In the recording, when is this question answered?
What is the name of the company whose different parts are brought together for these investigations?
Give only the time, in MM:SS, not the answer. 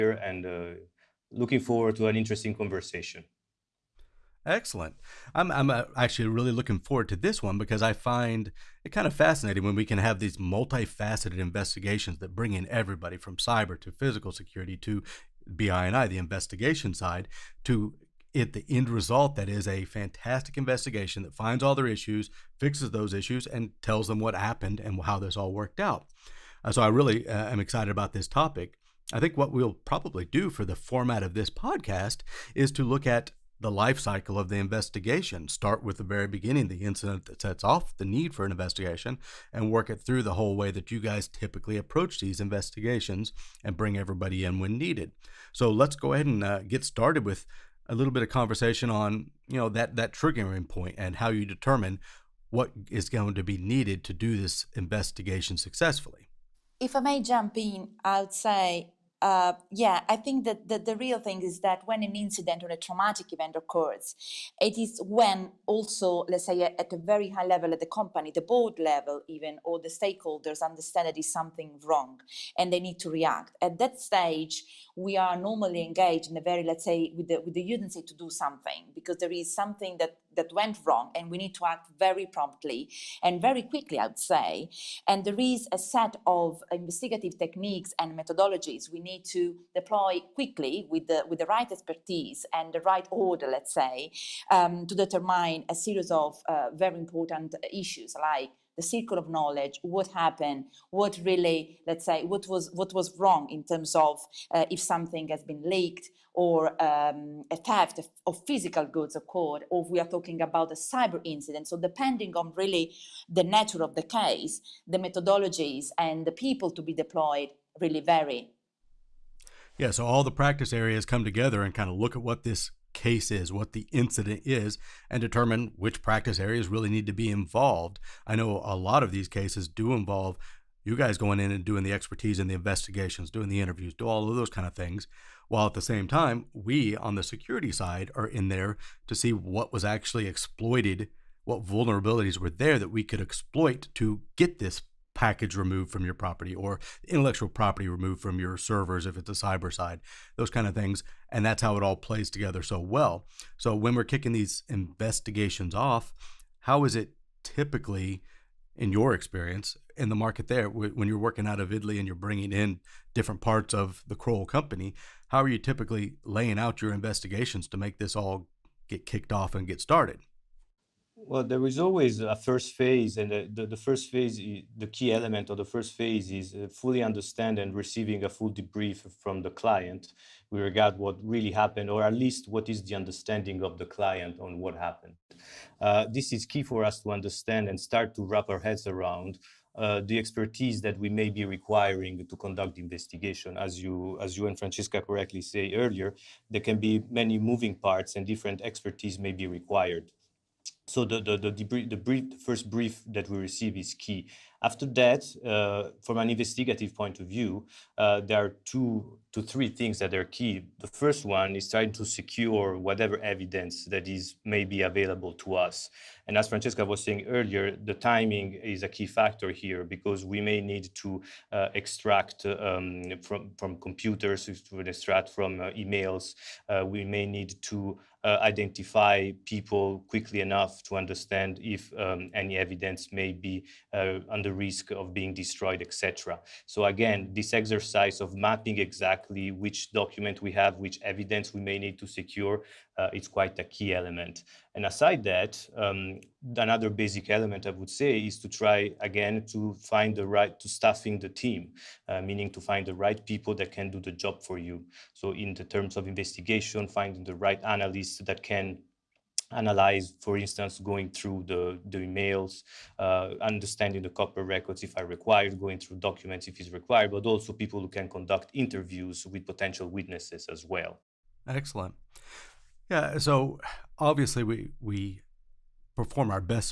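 02:44.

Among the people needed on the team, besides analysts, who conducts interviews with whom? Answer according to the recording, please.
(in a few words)
Potential witnesses.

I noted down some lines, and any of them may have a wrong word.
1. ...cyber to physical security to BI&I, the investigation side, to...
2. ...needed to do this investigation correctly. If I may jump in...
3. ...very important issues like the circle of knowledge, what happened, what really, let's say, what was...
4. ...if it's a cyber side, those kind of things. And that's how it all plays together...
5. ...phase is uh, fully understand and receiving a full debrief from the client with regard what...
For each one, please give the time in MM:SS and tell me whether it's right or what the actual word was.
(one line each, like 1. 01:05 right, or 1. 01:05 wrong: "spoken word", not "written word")
1. 00:13 right
2. 00:53 wrong: "successfully", not "correctly"
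3. 01:36 right
4. 02:29 right
5. 02:55 right.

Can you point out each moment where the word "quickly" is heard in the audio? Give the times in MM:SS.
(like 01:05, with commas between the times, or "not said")
01:23, 01:30, 03:50.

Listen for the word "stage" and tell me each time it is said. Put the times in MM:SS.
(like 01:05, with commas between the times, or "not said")
01:13.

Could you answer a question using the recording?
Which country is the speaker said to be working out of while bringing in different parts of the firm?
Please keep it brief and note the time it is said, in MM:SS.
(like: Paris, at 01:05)
Italy, at 02:41.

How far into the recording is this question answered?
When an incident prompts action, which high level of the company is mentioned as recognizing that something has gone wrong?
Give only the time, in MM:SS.
01:08.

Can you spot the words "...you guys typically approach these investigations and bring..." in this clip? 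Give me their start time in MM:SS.
00:40.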